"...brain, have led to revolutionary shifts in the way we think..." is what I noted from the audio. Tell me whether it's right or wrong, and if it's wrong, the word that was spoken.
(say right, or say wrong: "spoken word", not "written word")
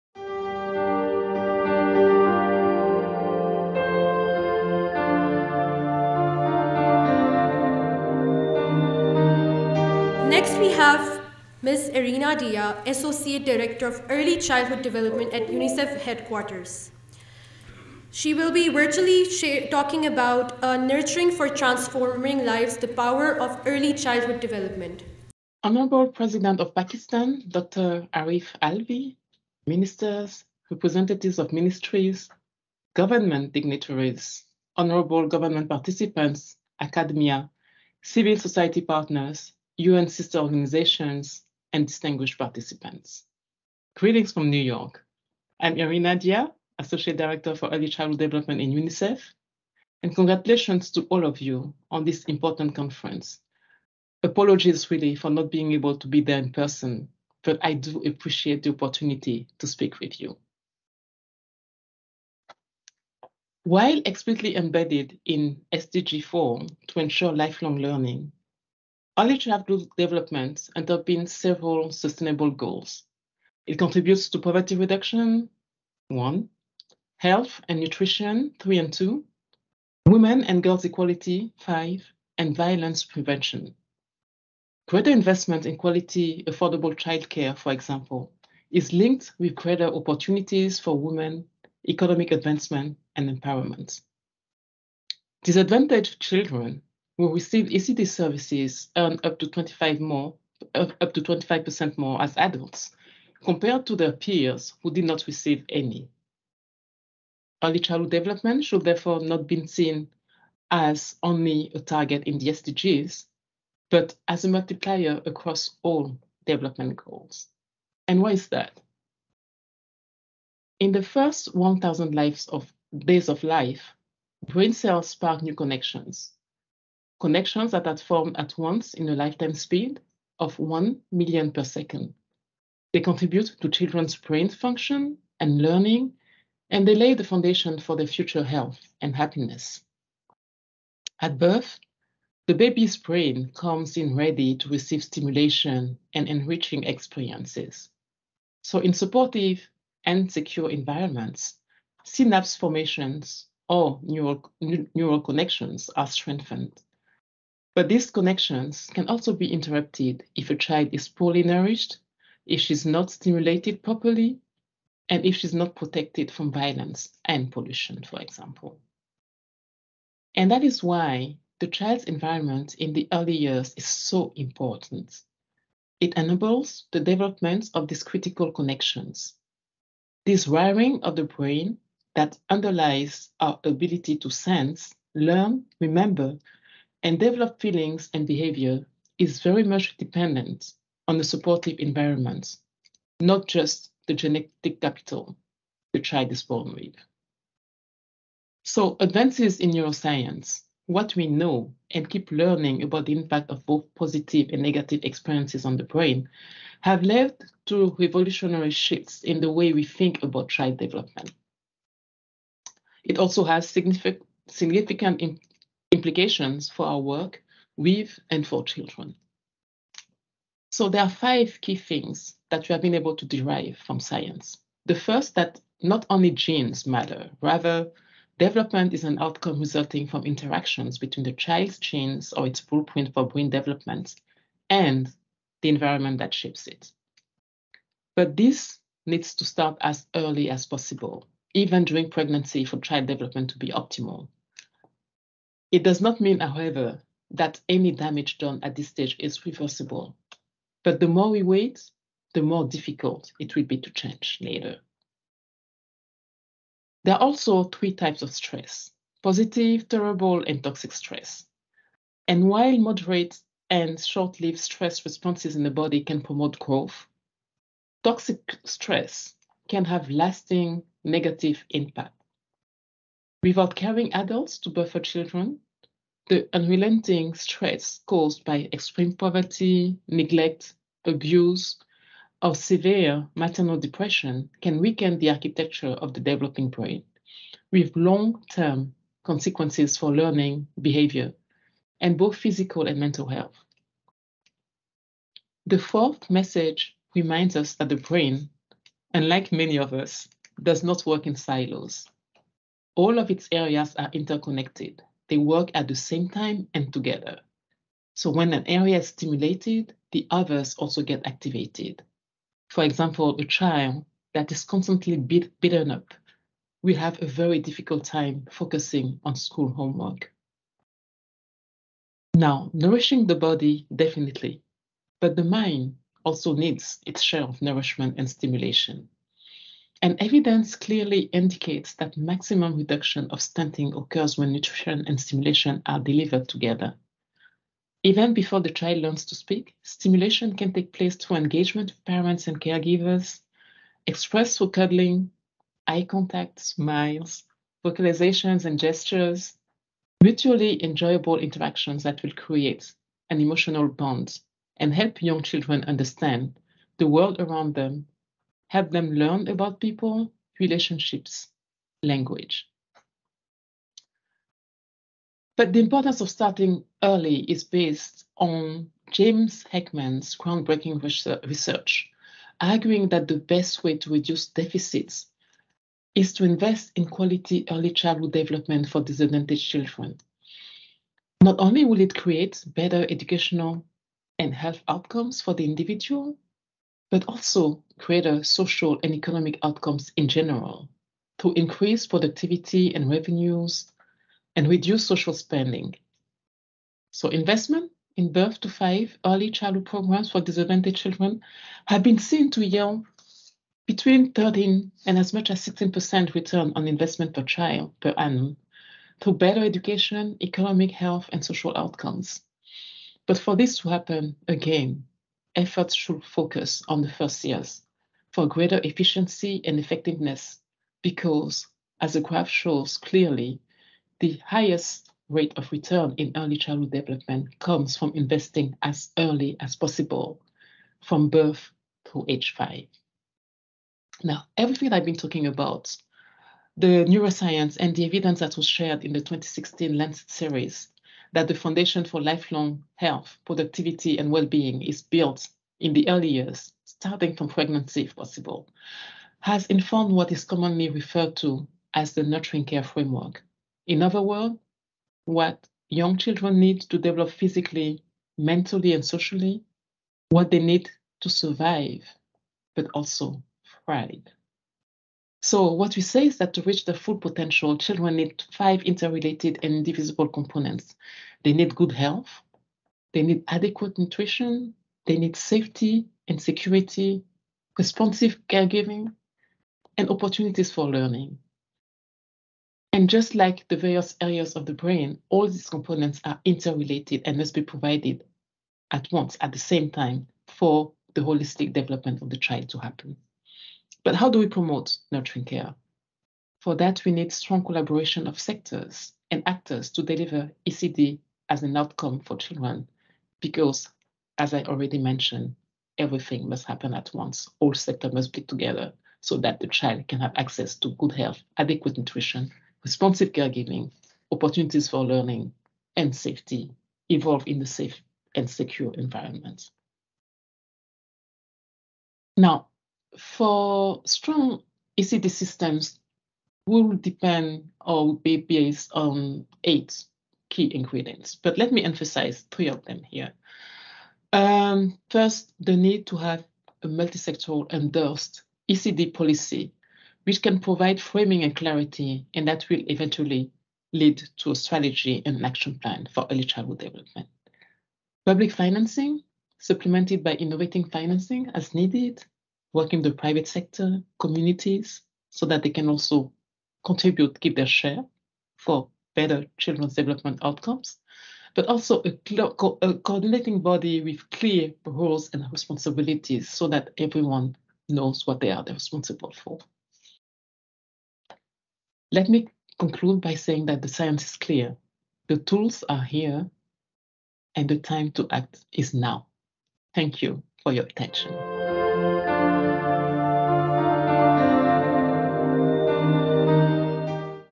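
right.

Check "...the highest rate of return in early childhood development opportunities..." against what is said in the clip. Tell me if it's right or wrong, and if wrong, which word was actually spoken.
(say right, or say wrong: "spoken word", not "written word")
wrong: "comes", not "opportunities".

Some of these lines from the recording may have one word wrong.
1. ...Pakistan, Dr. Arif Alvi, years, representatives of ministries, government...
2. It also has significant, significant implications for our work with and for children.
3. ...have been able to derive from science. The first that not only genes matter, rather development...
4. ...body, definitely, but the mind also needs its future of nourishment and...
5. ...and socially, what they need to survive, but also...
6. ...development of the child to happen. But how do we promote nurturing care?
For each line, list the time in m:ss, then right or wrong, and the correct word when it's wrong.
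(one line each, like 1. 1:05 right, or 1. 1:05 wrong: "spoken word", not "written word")
1. 0:26 wrong: "ministers", not "years"
2. 3:33 right
3. 3:42 right
4. 5:23 wrong: "share", not "future"
5. 7:38 right
6. 8:11 right.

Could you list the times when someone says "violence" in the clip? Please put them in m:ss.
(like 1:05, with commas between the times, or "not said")
1:22, 2:46.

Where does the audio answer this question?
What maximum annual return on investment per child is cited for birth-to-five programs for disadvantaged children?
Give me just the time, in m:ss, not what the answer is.
6:45.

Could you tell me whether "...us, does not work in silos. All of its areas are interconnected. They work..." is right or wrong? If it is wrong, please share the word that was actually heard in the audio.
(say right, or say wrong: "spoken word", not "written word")
right.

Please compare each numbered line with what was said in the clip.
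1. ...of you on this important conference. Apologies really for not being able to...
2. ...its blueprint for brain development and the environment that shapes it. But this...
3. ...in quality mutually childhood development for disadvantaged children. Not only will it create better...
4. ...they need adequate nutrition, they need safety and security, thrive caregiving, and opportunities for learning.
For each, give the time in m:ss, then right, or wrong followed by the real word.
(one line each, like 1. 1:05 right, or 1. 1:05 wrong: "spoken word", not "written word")
1. 0:51 right
2. 3:52 right
3. 6:16 wrong: "early", not "mutually"
4. 7:53 wrong: "responsive", not "thrive".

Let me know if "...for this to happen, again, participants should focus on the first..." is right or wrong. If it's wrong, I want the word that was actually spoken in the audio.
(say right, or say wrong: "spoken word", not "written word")
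wrong: "efforts", not "participants".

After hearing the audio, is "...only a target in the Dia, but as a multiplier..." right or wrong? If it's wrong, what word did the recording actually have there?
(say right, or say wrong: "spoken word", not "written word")
wrong: "SDGs", not "Dia".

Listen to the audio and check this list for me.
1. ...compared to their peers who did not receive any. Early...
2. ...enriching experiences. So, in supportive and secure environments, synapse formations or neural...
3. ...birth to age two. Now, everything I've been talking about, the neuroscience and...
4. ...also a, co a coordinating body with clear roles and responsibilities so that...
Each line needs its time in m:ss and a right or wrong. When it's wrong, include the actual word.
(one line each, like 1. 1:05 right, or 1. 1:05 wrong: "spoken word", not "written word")
1. 1:43 right
2. 2:26 right
3. 7:11 wrong: "five", not "two"
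4. 9:21 right.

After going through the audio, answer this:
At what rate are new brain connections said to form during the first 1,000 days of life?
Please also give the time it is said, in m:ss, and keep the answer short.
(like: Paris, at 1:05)
1 million per second, at 2:10.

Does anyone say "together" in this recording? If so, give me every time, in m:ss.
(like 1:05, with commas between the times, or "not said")
5:06, 5:36, 8:28.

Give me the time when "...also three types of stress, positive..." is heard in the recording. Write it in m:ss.
4:17.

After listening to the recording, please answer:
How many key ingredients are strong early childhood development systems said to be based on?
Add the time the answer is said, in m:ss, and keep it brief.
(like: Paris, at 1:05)
8, at 8:49.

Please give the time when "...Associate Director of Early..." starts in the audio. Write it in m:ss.
0:12.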